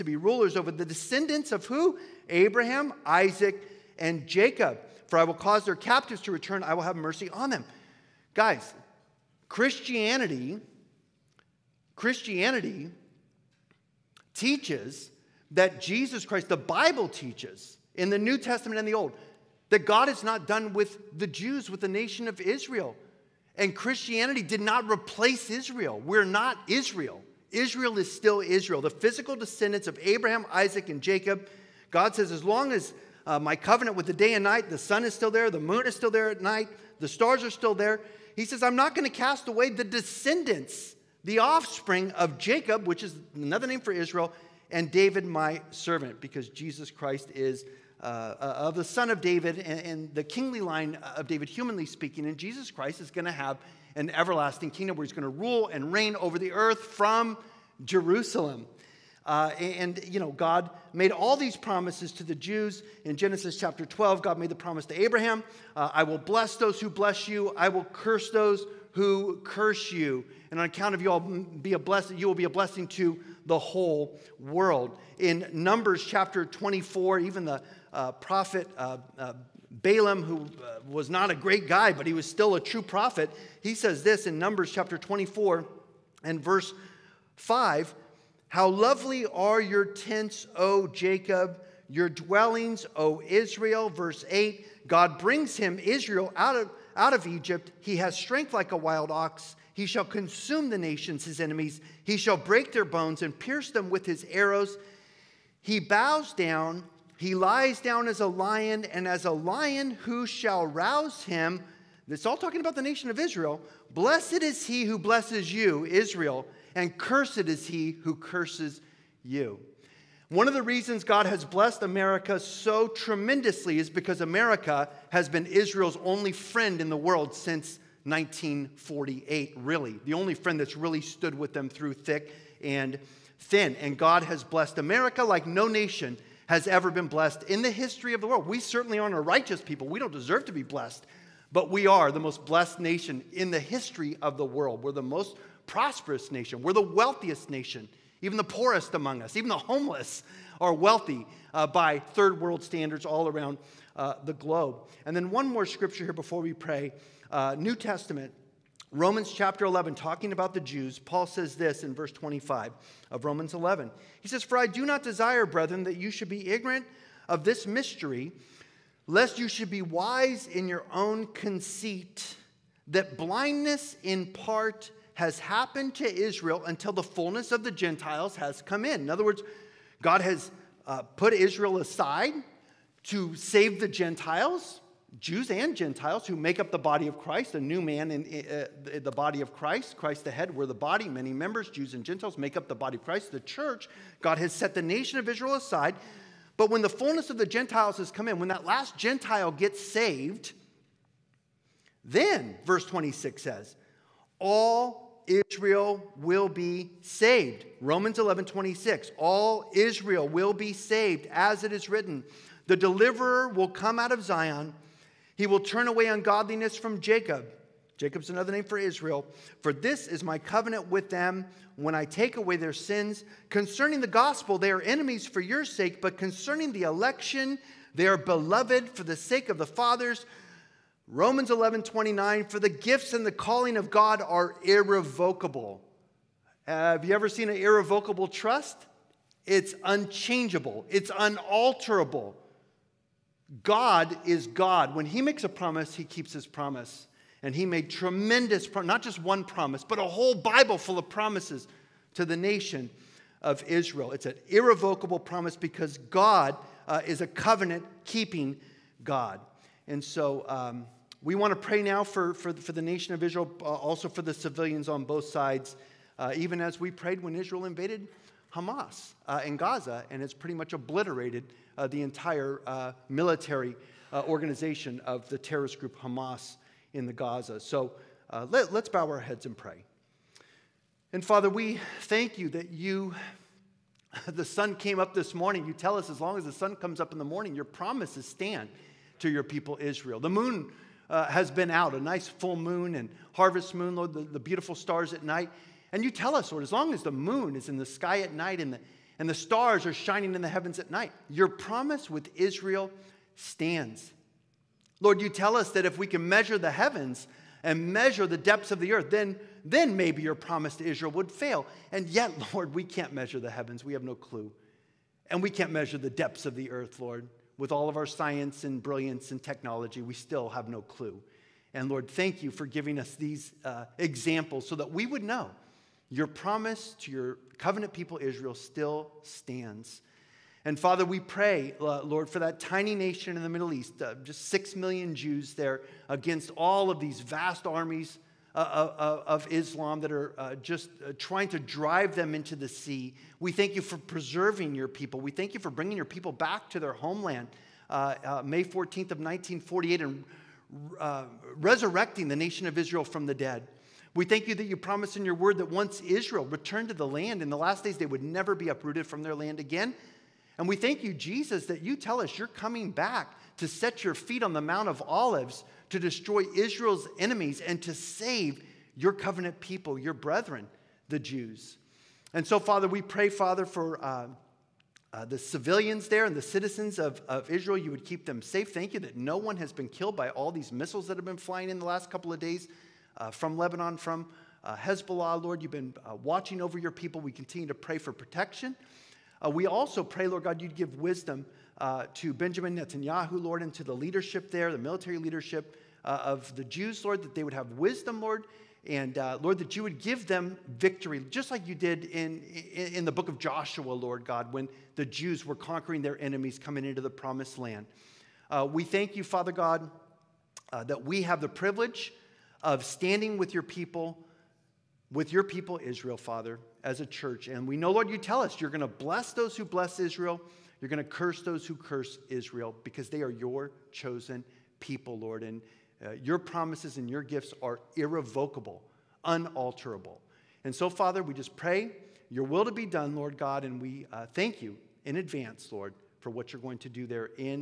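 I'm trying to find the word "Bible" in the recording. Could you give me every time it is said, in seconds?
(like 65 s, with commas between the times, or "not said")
16 s, 250 s.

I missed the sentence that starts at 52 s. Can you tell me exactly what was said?
And Jesus Christ is going to have an everlasting kingdom where he's going to rule and reign over the earth from Jerusalem.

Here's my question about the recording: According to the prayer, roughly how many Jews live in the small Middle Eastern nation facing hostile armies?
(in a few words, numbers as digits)
6 million.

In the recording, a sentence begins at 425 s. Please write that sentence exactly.
And uh, your promises and your gifts are irrevocable, unalterable.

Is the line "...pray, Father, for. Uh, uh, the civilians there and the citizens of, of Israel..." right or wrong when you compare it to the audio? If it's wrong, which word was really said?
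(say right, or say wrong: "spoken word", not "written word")
right.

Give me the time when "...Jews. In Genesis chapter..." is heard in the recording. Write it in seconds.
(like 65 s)
62 s.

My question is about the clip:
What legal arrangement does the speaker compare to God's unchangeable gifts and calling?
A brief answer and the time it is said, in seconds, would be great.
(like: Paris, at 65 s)
An irrevocable trust, at 237 s.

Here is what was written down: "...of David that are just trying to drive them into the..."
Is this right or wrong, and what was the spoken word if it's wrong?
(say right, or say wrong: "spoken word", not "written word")
wrong: "Islam", not "David".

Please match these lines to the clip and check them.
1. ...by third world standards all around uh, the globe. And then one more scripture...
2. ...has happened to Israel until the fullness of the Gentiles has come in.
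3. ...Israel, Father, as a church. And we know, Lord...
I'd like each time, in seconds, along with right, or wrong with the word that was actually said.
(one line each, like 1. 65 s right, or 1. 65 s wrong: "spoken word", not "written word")
1. 151 s right
2. 175 s right
3. 415 s right.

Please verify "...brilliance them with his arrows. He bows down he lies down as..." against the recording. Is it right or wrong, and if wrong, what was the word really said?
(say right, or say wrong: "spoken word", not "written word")
wrong: "pierce", not "brilliance".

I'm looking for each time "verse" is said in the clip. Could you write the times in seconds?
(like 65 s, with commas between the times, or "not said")
86 s, 93 s, 161 s, 202 s.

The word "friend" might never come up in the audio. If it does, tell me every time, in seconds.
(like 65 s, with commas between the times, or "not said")
126 s, 130 s.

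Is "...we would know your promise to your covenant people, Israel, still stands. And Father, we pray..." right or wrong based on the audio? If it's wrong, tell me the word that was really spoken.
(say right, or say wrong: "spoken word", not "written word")
right.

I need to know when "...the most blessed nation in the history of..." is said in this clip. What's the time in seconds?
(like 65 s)
142 s.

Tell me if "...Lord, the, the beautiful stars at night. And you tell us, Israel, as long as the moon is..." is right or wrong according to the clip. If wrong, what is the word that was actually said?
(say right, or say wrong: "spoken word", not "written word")
wrong: "Lord", not "Israel".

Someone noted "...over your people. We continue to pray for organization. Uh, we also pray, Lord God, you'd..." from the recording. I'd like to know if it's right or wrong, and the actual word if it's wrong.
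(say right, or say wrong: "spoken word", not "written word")
wrong: "protection", not "organization".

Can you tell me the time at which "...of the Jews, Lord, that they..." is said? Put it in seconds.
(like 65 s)
396 s.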